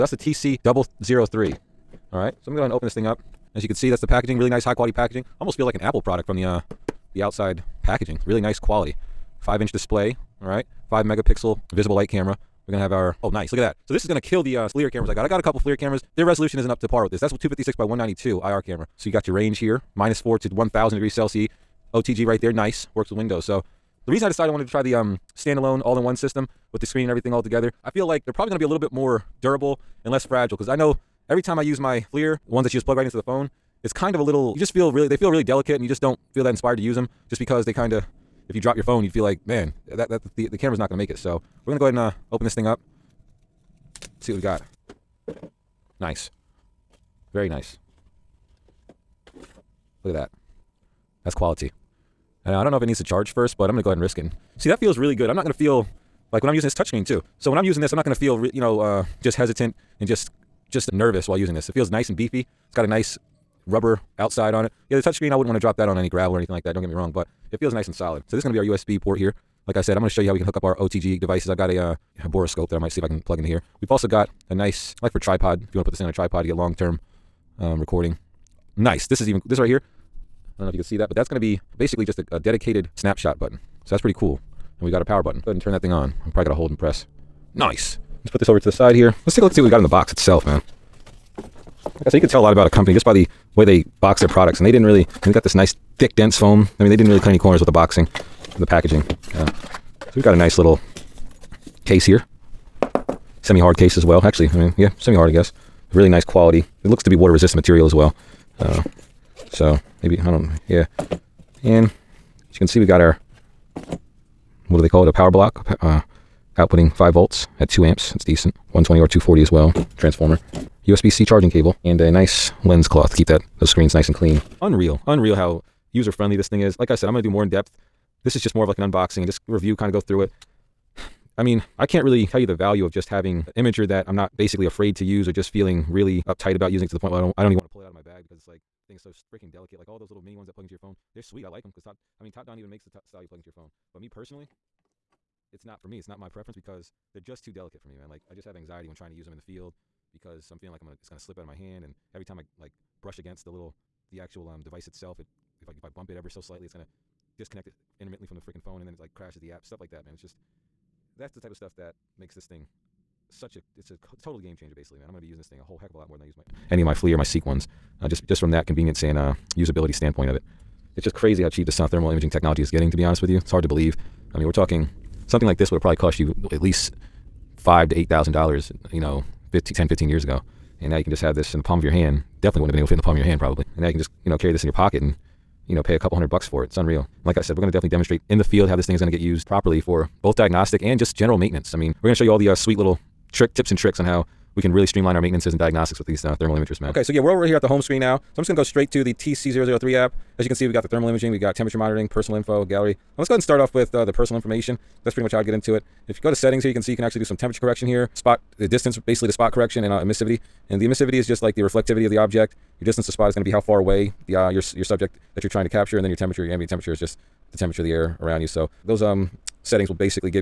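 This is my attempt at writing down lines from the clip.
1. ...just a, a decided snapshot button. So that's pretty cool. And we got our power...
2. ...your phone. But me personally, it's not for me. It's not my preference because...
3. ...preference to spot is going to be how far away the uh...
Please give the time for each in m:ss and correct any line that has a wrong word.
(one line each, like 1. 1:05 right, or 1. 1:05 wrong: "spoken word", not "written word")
1. 1:22 wrong: "dedicated", not "decided"
2. 2:23 right
3. 3:32 wrong: "distance", not "preference".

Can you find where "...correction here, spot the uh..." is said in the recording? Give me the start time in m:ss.
3:27.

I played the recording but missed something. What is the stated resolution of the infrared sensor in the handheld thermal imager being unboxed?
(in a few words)
256 by 192.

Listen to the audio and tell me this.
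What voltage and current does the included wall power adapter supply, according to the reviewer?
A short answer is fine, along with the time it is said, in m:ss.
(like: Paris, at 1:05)
5 volts at 2 amps, at 1:56.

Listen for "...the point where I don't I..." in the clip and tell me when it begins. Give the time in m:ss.
2:16.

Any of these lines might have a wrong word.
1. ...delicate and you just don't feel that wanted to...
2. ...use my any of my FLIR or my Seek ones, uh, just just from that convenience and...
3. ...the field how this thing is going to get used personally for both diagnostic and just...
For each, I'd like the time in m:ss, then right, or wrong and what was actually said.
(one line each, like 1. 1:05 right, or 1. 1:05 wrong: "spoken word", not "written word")
1. 0:35 wrong: "inspired", not "wanted"
2. 2:46 right
3. 3:08 wrong: "properly", not "personally".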